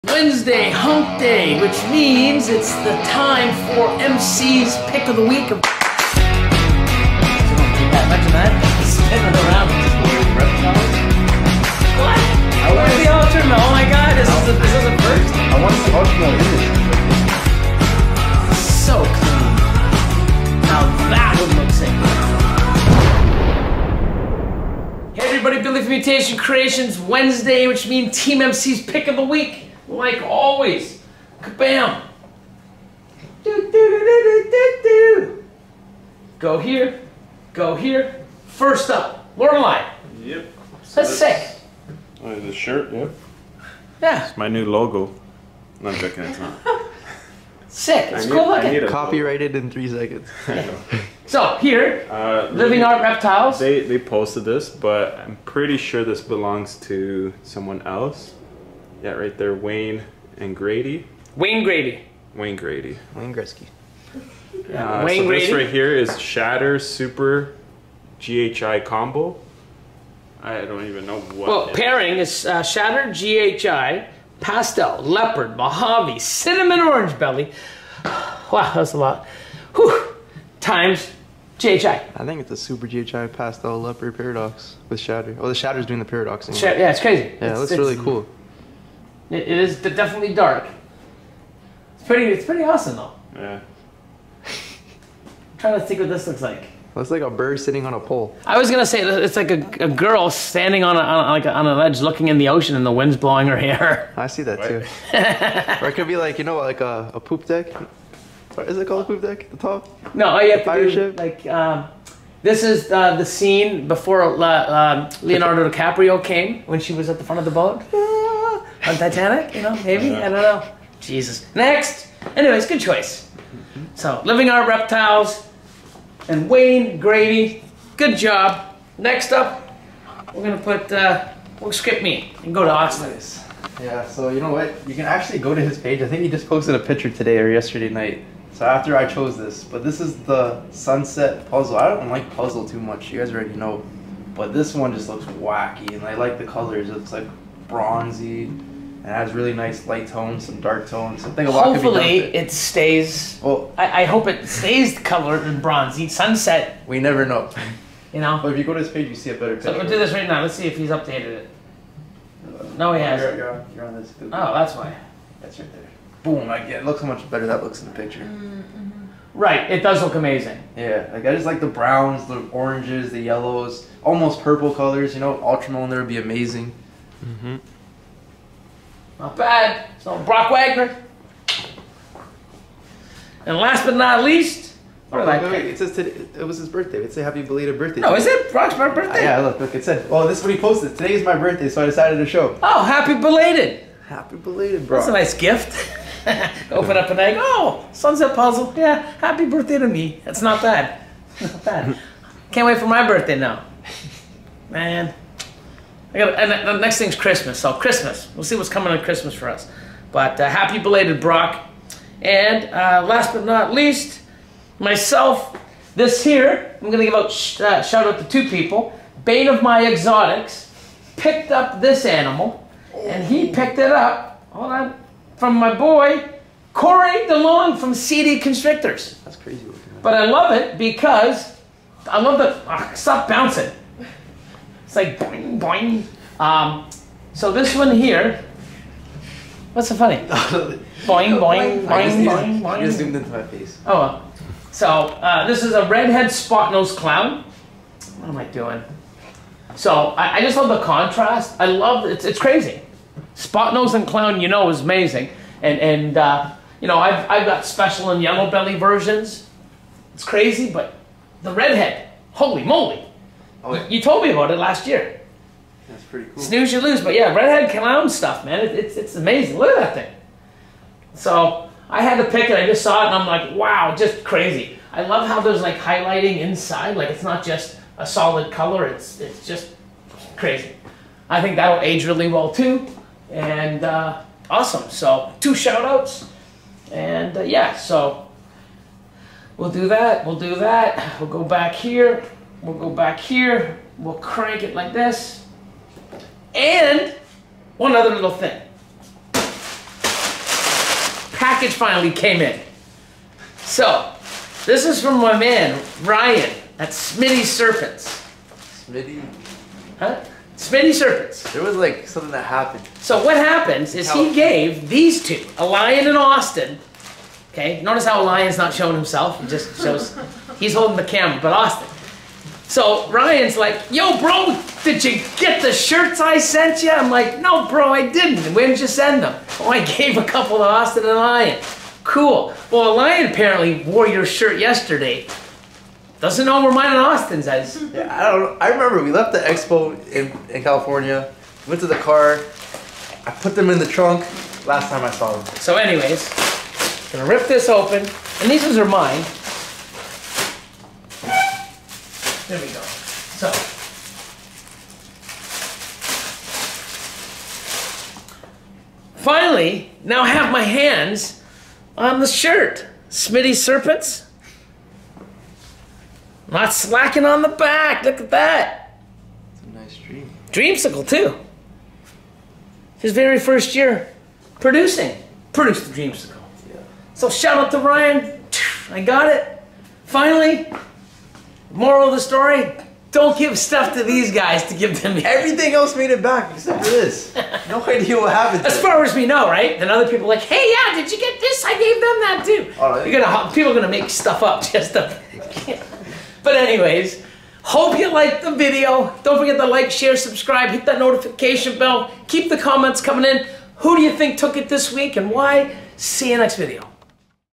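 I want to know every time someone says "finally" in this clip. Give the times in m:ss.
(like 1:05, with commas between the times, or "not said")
5:01, 5:59, 6:20.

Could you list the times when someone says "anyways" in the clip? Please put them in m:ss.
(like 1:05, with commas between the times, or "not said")
2:02, 5:45, 6:36.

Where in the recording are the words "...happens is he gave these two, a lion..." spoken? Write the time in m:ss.
5:13.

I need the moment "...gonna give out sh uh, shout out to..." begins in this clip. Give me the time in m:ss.
3:36.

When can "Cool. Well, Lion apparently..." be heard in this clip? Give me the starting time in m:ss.
5:32.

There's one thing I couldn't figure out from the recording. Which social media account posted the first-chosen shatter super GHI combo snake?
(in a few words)
Living Art Reptiles.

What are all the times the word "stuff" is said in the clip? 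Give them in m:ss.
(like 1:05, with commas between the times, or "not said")
4:28, 6:23, 6:34.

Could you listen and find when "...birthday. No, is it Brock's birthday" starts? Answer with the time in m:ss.
3:07.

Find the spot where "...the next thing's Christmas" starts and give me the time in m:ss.
3:26.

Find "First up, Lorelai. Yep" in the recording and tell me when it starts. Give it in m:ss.
0:38.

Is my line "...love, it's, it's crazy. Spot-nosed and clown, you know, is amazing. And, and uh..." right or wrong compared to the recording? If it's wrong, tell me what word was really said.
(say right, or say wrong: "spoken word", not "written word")
right.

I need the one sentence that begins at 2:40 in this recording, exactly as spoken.
Let's see if he's updated it.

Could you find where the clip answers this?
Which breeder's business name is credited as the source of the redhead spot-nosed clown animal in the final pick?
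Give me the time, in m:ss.
3:47.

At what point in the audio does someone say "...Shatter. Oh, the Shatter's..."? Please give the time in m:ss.
1:24.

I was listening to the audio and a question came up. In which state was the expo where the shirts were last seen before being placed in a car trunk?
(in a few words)
California.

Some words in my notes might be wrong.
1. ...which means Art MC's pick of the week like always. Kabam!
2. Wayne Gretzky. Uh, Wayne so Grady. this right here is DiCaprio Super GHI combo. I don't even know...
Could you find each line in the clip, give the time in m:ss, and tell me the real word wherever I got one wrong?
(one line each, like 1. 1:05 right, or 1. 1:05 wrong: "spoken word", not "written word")
1. 0:27 wrong: "Team", not "Art"
2. 1:03 wrong: "Shatter", not "DiCaprio".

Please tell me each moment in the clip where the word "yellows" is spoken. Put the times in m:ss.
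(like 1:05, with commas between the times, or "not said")
2:53, 4:18.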